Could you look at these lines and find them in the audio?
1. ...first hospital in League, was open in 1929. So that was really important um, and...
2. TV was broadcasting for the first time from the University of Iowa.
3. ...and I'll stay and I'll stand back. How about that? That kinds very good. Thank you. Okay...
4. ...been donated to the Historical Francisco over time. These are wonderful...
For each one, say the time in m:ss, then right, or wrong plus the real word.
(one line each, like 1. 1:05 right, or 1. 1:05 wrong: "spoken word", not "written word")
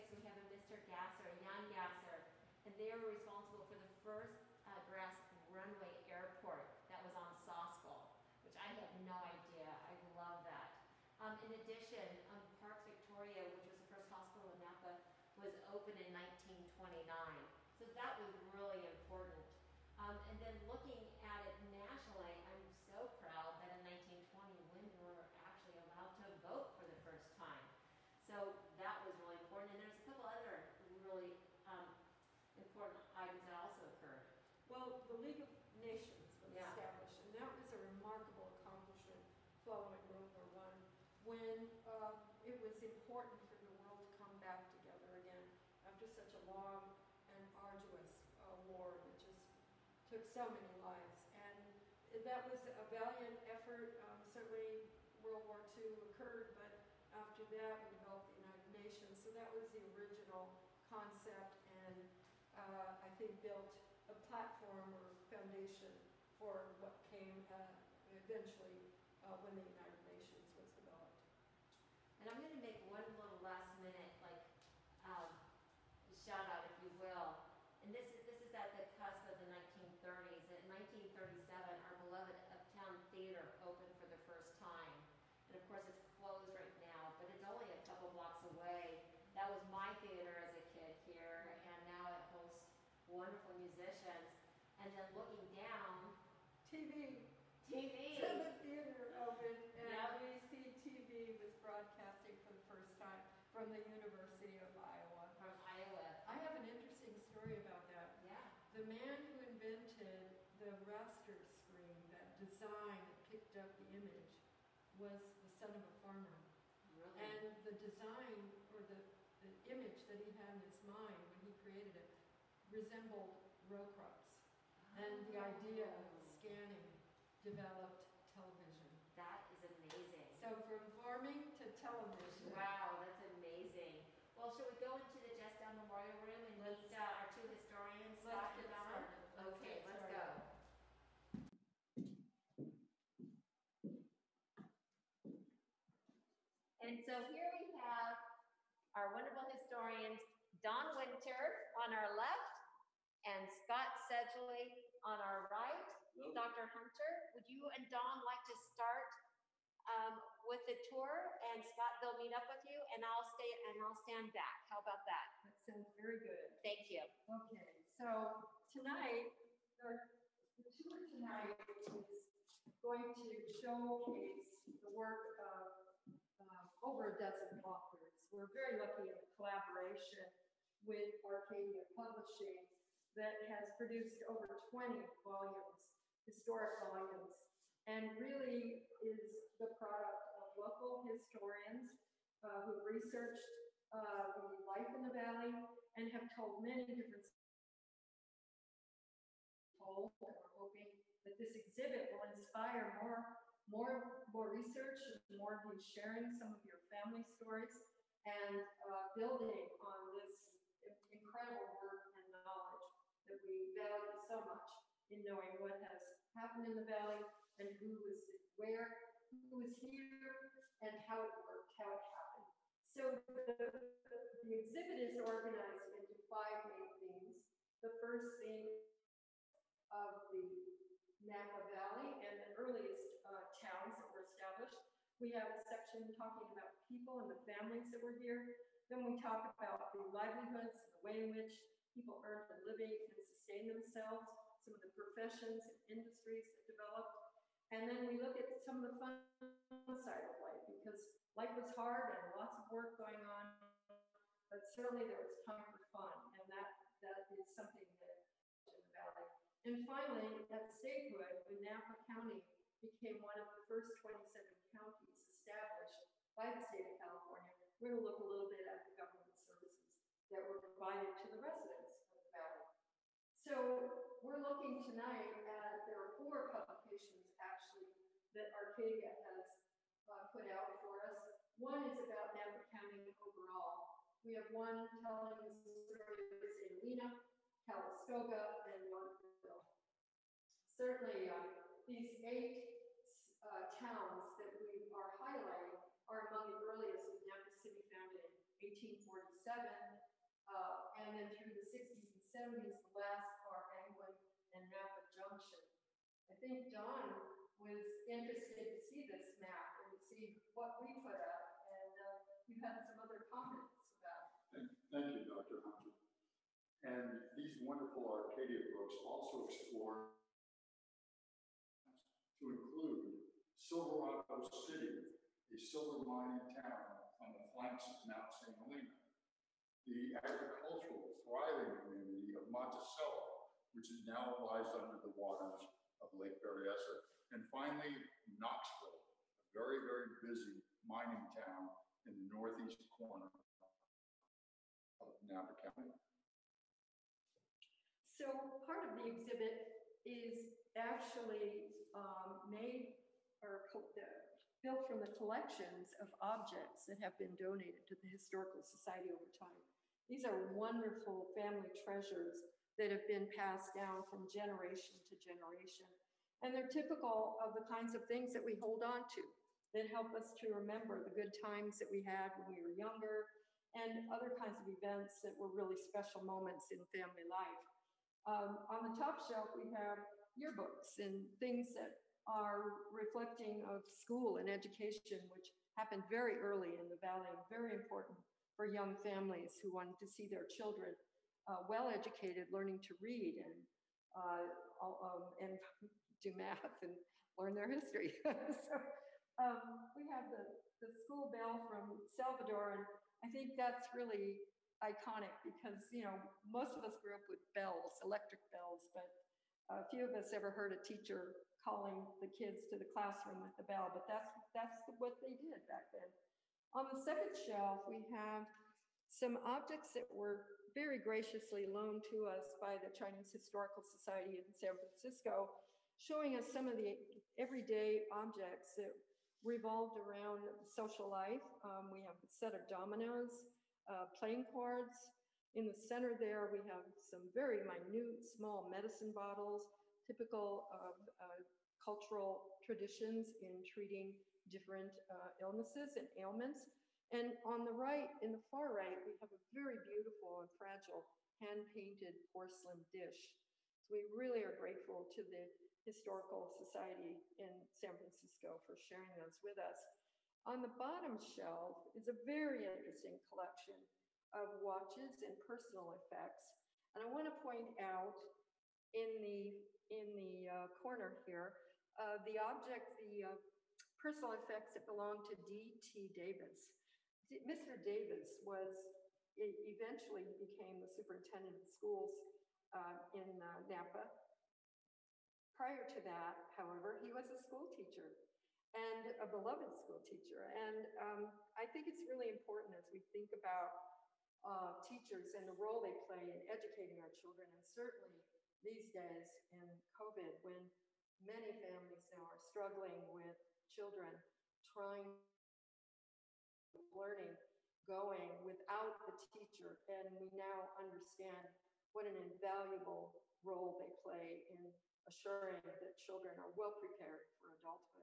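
1. 0:13 wrong: "Napa", not "League"
2. 1:40 right
3. 2:42 wrong: "sounds", not "kinds"
4. 5:57 wrong: "Society", not "Francisco".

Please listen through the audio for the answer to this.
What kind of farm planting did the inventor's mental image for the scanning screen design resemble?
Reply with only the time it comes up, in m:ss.
2:03.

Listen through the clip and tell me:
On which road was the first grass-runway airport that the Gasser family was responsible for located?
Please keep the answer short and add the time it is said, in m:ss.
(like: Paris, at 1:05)
Soscol, at 0:07.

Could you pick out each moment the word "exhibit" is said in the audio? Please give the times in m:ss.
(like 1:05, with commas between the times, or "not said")
3:21, 3:44, 5:49.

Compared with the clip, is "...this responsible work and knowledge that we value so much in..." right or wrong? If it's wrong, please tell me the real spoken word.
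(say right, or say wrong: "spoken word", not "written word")
wrong: "incredible", not "responsible".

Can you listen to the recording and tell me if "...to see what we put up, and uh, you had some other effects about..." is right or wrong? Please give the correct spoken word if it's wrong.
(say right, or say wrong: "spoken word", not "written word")
wrong: "comments", not "effects".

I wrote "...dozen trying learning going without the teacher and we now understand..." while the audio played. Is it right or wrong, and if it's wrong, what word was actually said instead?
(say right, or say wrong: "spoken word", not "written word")
wrong: "children", not "dozen".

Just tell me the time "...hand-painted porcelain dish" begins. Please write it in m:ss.
7:31.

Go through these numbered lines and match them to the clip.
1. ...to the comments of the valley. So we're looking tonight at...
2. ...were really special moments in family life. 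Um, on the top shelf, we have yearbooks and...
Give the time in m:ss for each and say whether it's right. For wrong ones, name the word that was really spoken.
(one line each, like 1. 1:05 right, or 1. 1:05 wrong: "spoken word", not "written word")
1. 4:31 wrong: "residents", not "comments"
2. 6:15 right.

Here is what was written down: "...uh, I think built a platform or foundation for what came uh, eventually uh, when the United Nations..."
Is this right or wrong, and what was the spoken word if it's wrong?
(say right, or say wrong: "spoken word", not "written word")
right.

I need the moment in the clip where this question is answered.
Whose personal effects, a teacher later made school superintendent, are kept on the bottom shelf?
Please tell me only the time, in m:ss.
7:55.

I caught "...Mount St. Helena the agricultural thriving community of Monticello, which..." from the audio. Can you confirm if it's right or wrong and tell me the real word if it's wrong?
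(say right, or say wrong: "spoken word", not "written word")
right.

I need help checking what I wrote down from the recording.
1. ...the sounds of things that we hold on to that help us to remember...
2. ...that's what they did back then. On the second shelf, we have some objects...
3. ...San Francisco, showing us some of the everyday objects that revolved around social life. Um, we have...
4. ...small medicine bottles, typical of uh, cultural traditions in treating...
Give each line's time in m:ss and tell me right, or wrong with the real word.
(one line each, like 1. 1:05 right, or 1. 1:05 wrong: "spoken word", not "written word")
1. 6:07 wrong: "kinds", not "sounds"
2. 6:54 right
3. 7:04 right
4. 7:18 right.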